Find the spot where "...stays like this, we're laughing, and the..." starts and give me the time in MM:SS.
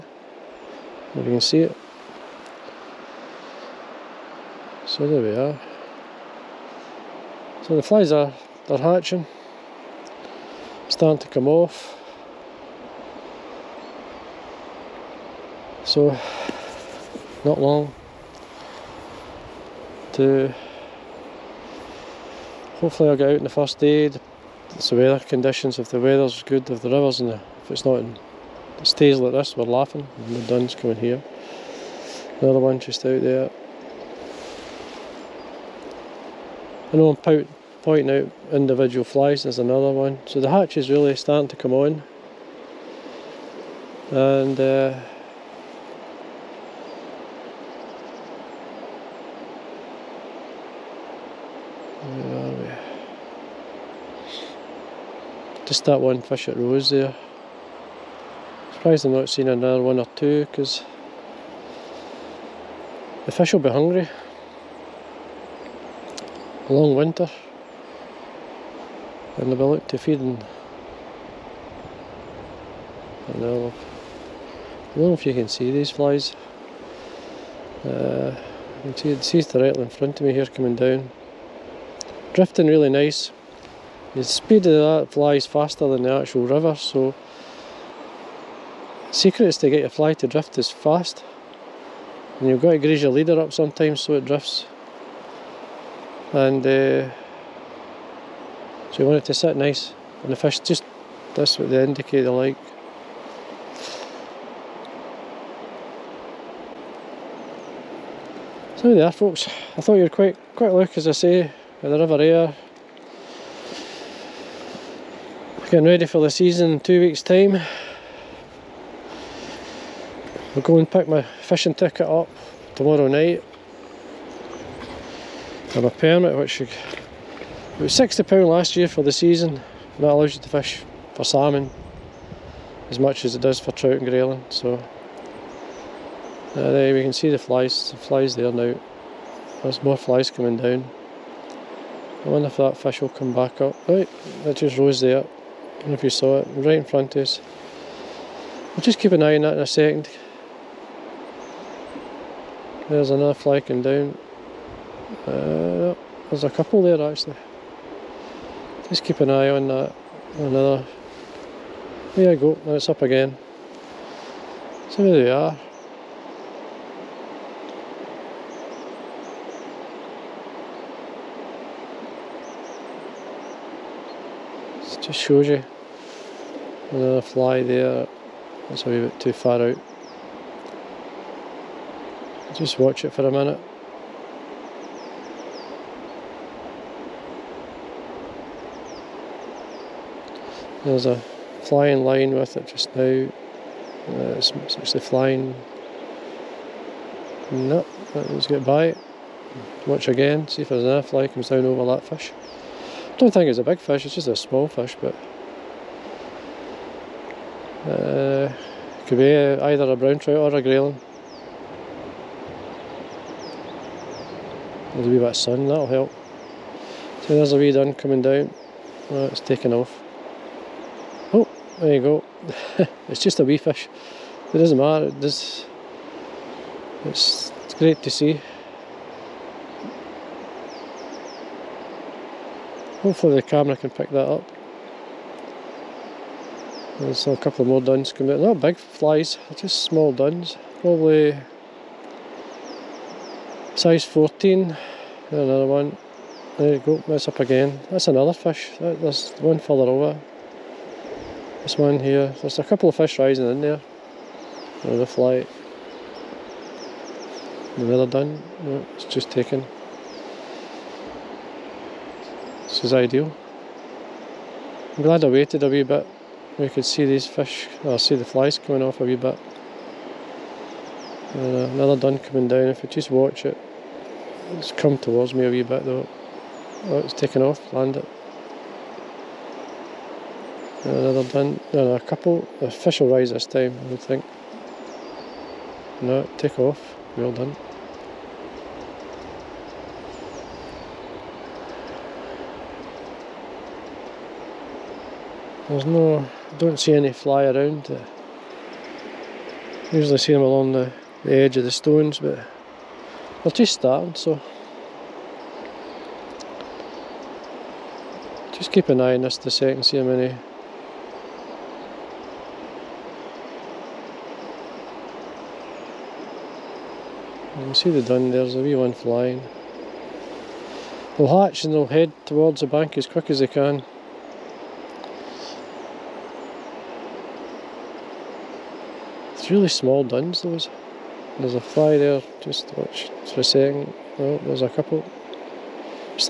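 00:28.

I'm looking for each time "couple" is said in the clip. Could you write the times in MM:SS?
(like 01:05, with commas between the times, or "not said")
02:36, 03:57, 04:12, 04:41, 05:34.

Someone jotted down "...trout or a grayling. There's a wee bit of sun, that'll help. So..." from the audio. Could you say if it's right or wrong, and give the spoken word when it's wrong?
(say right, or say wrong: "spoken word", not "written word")
right.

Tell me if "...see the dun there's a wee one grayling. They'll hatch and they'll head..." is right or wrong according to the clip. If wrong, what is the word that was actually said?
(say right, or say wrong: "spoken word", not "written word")
wrong: "flying", not "grayling".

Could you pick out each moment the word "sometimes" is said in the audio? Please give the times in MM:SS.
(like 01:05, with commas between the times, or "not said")
01:33.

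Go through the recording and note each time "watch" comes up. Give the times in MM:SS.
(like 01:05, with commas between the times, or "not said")
03:02, 03:19, 04:33, 05:32.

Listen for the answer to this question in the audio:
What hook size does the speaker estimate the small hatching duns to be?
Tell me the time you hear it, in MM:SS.
04:03.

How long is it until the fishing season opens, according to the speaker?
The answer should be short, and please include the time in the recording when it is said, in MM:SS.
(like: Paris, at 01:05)
2 weeks, at 01:56.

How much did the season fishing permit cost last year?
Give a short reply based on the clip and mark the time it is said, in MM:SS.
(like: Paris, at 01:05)
£60, at 02:07.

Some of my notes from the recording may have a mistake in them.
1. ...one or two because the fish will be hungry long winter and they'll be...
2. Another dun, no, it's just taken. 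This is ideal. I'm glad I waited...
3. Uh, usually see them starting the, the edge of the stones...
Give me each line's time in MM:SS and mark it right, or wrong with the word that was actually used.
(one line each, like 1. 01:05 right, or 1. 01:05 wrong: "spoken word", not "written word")
1. 00:59 right
2. 04:17 right
3. 04:57 wrong: "along", not "starting".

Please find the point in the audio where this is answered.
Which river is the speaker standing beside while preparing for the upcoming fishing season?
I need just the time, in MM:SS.
01:51.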